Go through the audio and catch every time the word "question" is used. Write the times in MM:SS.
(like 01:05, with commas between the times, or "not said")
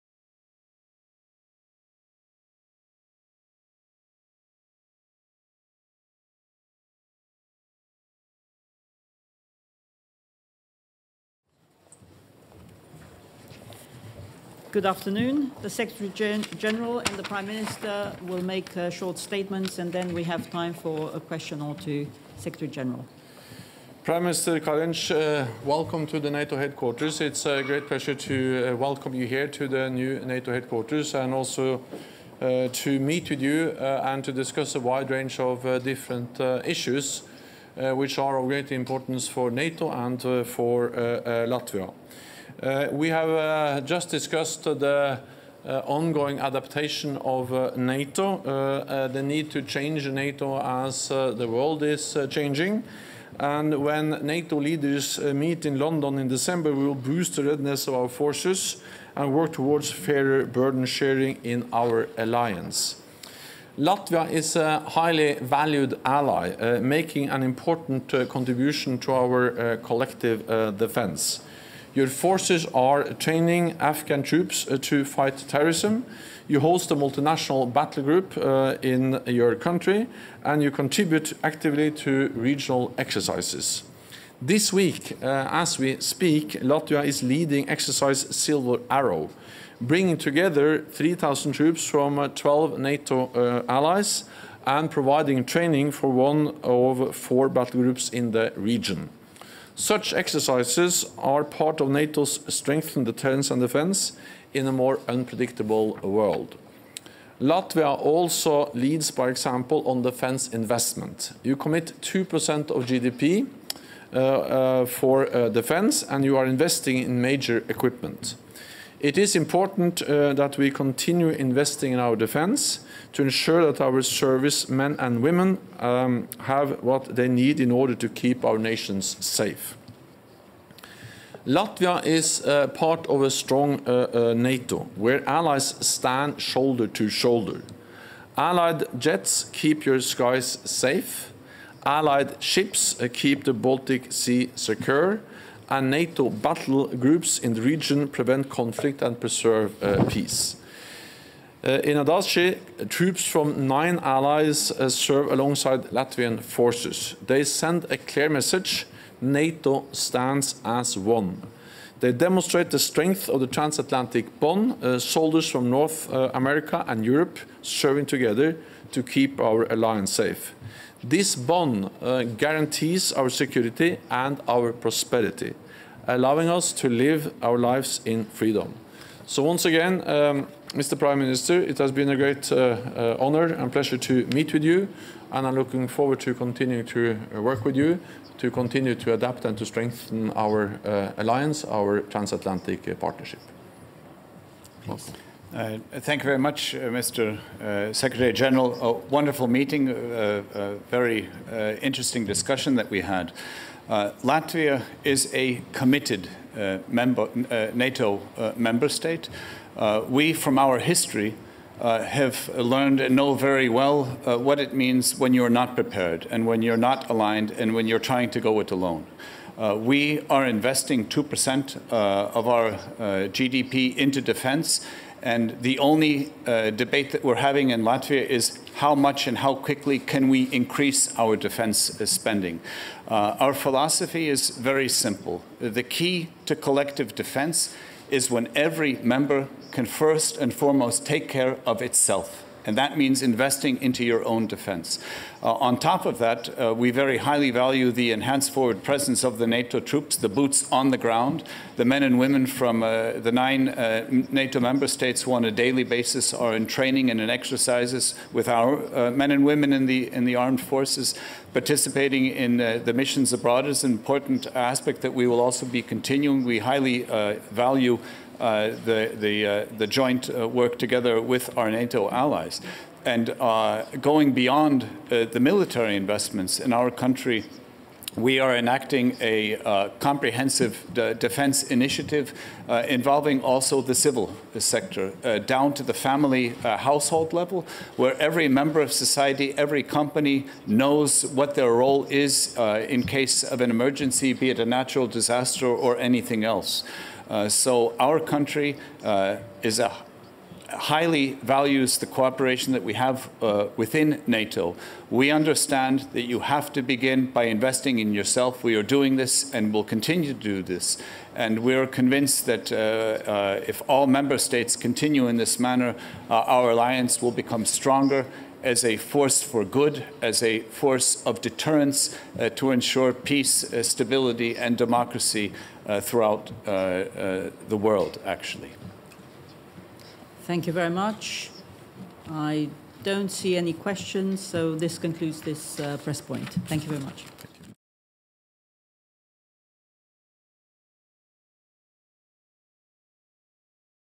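00:21, 05:33.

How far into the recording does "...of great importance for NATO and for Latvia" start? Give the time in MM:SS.
00:38.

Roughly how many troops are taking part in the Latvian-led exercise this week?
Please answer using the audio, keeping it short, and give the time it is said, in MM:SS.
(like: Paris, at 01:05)
3,000, at 01:30.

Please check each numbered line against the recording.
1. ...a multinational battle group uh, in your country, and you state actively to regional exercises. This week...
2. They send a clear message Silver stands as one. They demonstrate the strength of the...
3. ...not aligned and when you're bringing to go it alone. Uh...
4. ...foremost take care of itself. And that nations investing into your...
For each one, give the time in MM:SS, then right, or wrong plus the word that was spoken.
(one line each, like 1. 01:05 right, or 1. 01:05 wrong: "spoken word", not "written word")
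1. 01:16 wrong: "contribute", not "state"
2. 02:37 wrong: "NATO", not "Silver"
3. 03:36 wrong: "trying", not "bringing"
4. 04:00 wrong: "means", not "nations".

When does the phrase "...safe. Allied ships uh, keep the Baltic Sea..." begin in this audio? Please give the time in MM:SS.
02:20.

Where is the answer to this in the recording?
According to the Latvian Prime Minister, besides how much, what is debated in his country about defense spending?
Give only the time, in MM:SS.
03:49.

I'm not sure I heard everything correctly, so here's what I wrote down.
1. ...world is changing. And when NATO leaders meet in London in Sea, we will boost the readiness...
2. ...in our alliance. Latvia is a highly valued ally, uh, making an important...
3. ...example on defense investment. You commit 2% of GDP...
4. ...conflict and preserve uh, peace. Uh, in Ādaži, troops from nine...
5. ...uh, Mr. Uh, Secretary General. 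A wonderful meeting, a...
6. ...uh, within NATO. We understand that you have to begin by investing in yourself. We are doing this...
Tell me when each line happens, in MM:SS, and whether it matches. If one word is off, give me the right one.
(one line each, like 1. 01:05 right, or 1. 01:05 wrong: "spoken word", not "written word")
1. 00:51 wrong: "December", not "Sea"
2. 01:01 right
3. 01:49 right
4. 02:28 right
5. 03:16 right
6. 05:03 right.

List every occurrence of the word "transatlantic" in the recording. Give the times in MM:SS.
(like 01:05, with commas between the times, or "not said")
02:43, 03:11.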